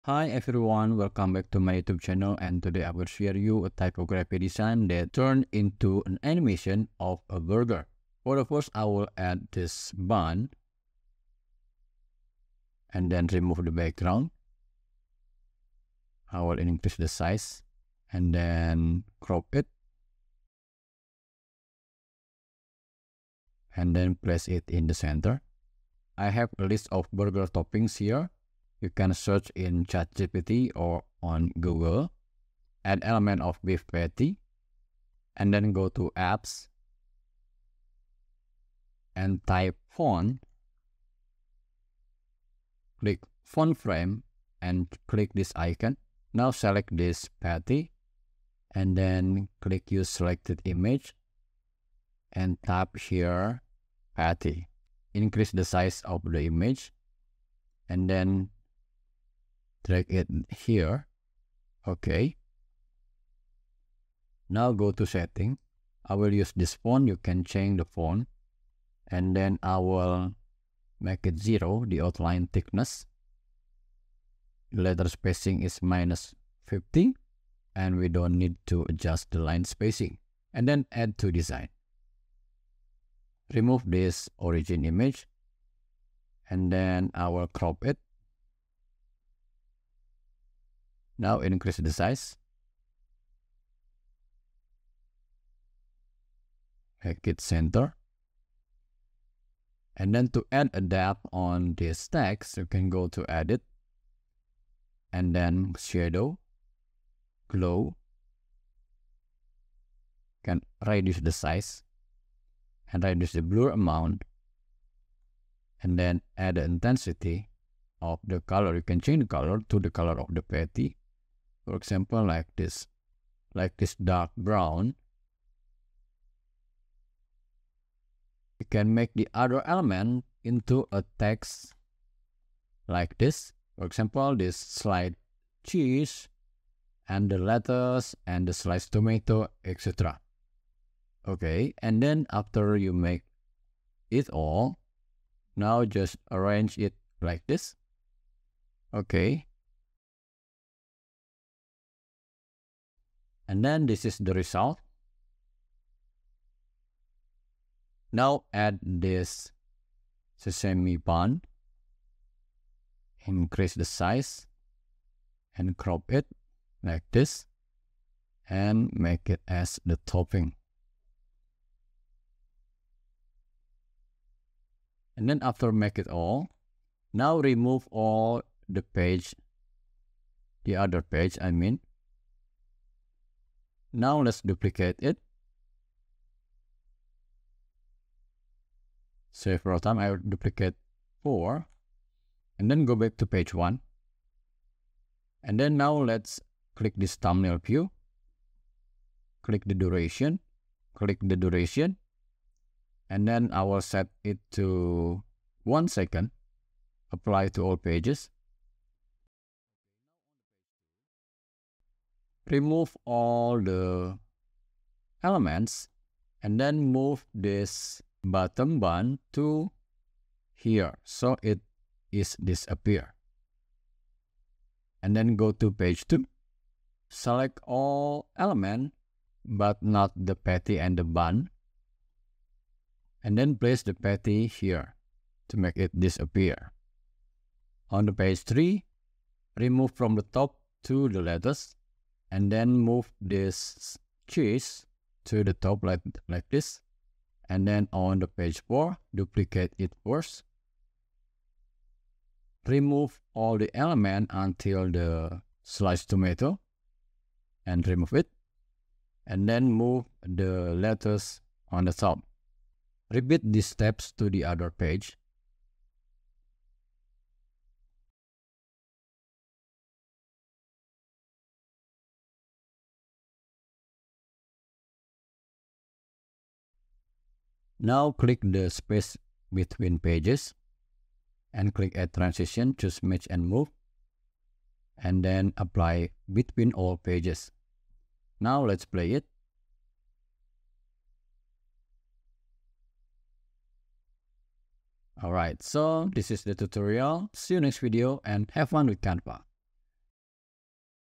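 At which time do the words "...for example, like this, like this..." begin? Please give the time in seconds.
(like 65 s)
121 s.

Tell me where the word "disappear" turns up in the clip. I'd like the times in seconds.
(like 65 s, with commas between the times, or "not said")
222 s, 235 s.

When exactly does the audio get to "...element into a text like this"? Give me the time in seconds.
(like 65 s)
129 s.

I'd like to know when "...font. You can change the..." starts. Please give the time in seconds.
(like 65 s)
66 s.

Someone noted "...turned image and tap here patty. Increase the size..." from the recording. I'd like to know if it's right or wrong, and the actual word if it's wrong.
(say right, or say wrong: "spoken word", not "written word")
wrong: "selected", not "turned".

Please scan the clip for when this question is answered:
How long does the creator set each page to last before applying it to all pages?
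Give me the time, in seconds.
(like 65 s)
205 s.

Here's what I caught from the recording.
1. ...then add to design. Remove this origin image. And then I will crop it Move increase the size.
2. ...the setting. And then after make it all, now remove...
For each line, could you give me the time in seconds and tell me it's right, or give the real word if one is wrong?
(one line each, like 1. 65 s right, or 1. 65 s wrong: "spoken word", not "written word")
1. 80 s wrong: "Now", not "Move"
2. 169 s wrong: "topping", not "setting".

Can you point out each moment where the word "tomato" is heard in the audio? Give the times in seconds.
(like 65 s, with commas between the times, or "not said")
138 s, 256 s.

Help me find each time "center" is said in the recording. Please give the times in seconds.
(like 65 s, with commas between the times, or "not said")
24 s, 97 s.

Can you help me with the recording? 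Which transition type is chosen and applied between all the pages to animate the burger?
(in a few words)
Match and Move.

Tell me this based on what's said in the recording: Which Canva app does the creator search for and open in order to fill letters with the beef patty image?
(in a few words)
Font Frame.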